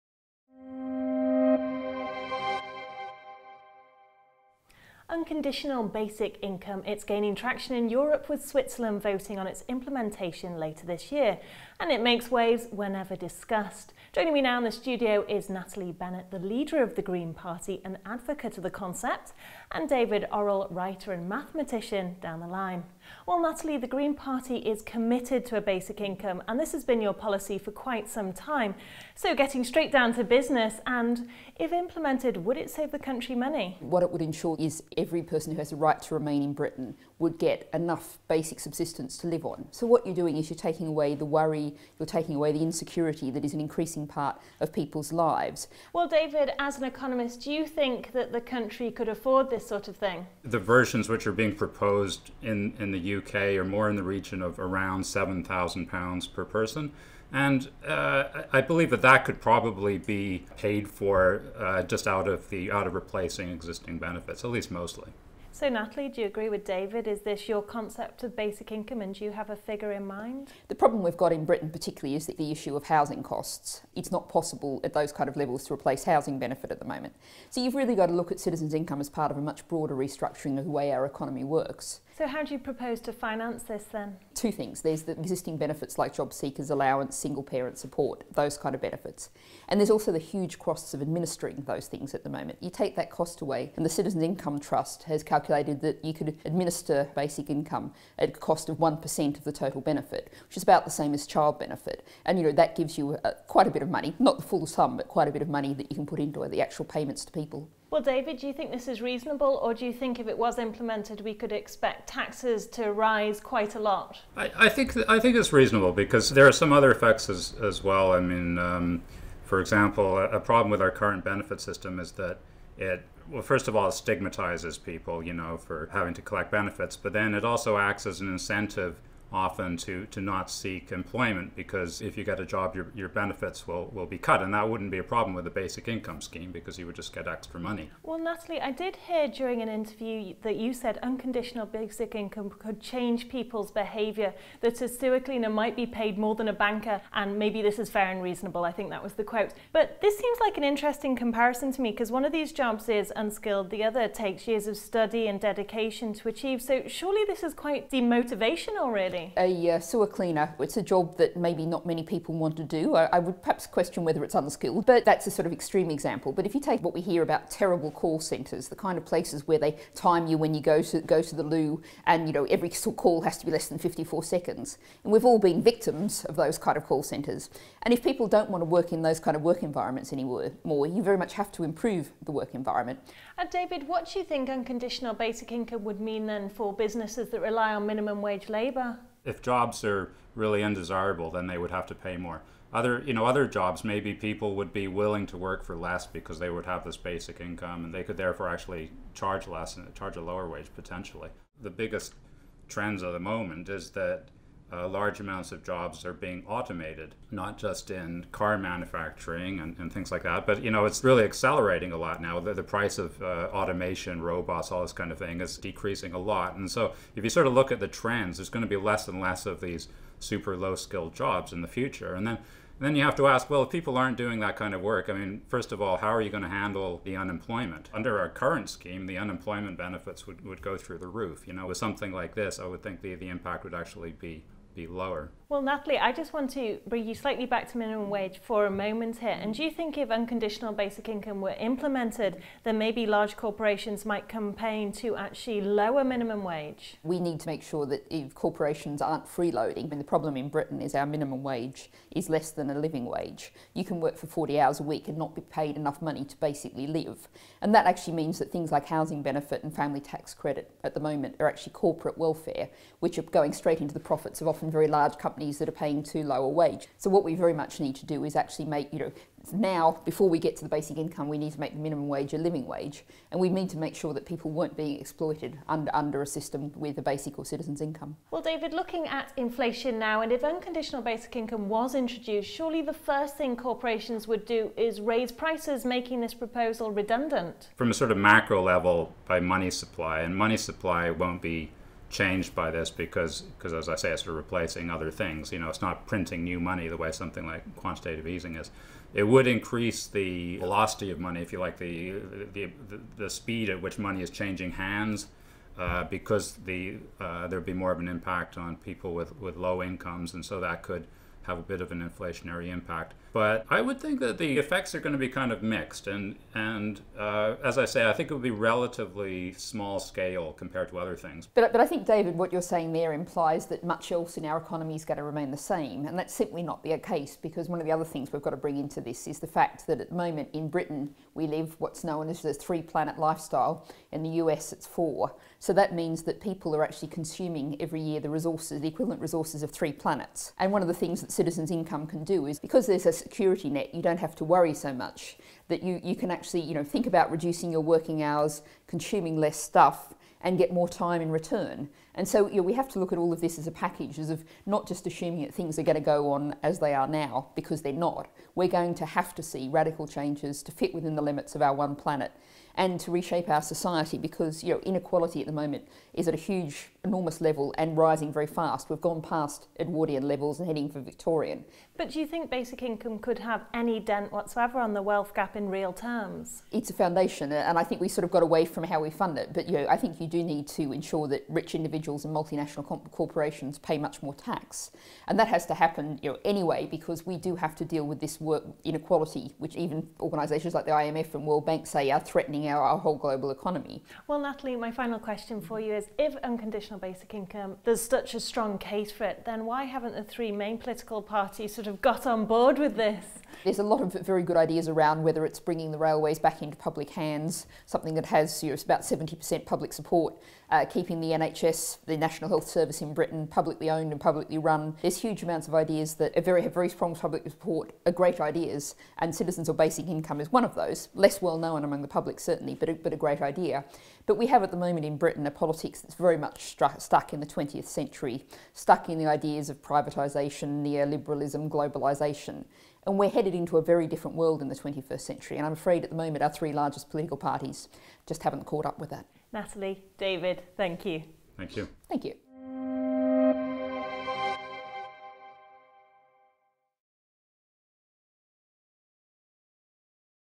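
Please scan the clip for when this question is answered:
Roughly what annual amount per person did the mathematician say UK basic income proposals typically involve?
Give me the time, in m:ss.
0:55.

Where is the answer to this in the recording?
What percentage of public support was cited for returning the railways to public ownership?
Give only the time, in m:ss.
6:49.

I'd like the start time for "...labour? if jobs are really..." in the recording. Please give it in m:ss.
3:08.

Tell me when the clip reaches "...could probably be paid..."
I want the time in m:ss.
0:59.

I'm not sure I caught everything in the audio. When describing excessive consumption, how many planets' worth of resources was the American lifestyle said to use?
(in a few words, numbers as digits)
4.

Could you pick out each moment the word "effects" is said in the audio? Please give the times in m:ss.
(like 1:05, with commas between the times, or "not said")
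1:56, 5:14.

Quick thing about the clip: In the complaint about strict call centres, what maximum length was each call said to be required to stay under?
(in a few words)
54 seconds.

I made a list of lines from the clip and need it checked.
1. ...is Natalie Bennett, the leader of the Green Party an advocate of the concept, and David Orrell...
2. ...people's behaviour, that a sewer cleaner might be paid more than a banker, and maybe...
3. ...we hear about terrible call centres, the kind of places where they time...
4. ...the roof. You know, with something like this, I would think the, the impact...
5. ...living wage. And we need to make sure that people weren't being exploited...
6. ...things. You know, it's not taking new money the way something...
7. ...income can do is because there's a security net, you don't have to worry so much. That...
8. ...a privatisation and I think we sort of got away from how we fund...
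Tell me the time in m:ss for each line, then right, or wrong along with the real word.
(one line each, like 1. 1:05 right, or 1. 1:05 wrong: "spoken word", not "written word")
1. 0:15 right
2. 2:23 right
3. 2:46 right
4. 3:50 right
5. 4:32 right
6. 4:55 wrong: "printing", not "taking"
7. 5:41 right
8. 6:16 wrong: "foundation", not "privatisation".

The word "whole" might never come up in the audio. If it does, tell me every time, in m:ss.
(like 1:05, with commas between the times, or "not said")
6:32.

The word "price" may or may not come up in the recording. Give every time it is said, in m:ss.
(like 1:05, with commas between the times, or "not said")
3:32, 4:45.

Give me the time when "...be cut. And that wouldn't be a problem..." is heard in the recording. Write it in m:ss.
2:14.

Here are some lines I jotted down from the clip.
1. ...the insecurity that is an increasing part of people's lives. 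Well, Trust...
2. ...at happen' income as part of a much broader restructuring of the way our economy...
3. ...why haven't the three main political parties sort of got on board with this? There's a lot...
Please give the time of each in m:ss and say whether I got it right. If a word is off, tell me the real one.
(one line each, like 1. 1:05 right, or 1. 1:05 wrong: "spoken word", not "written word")
1. 0:42 wrong: "David", not "Trust"
2. 1:18 wrong: "citizens", not "happen"
3. 6:39 right.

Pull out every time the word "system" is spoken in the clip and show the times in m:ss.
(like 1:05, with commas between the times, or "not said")
2:01, 4:36.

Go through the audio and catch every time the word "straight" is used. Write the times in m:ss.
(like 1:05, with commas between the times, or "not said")
0:29, 4:23.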